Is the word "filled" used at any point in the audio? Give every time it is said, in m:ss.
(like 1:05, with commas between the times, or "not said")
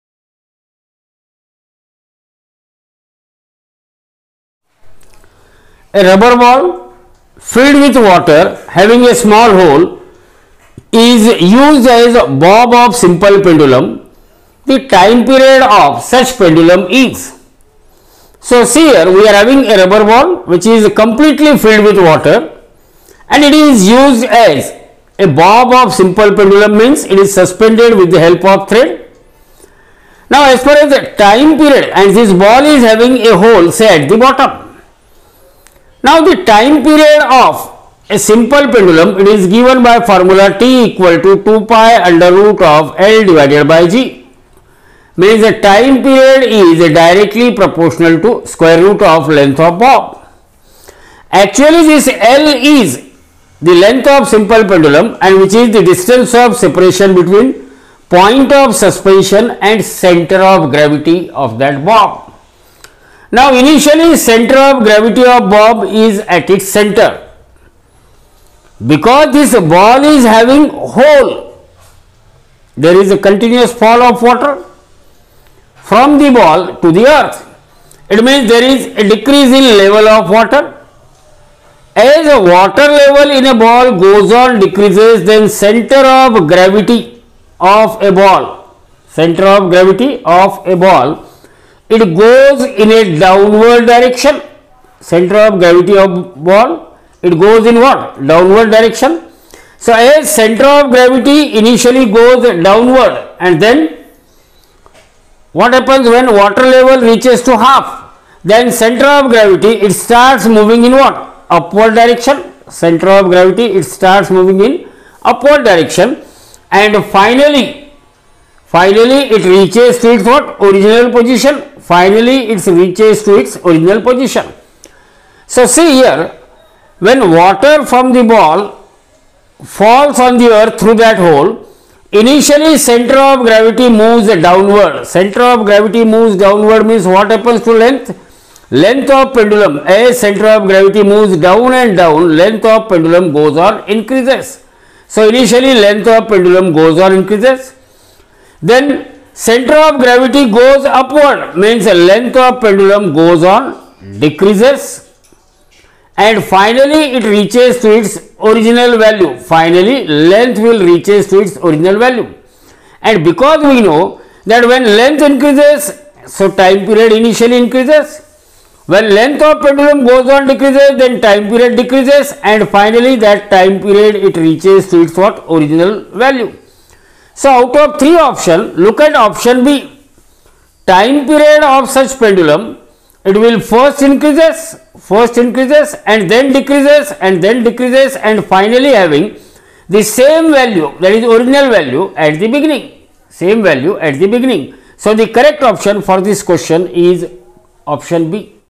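0:07, 0:21.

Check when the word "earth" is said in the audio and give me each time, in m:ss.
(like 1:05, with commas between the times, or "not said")
1:17, 2:10.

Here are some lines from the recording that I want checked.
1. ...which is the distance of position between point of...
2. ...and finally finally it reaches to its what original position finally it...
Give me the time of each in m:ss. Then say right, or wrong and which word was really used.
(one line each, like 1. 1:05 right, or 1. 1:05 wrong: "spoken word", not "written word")
1. 0:55 wrong: "separation", not "position"
2. 1:56 right.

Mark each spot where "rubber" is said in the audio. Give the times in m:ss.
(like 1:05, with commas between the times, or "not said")
0:06, 0:19.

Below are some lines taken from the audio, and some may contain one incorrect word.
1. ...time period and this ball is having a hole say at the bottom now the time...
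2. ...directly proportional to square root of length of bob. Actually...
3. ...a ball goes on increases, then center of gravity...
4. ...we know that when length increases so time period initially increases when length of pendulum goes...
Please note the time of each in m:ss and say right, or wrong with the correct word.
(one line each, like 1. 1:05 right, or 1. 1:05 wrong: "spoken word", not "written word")
1. 0:31 right
2. 0:46 right
3. 1:23 wrong: "decreases", not "increases"
4. 2:43 right.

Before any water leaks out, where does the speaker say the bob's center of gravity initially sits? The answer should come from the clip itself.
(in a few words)
At its center.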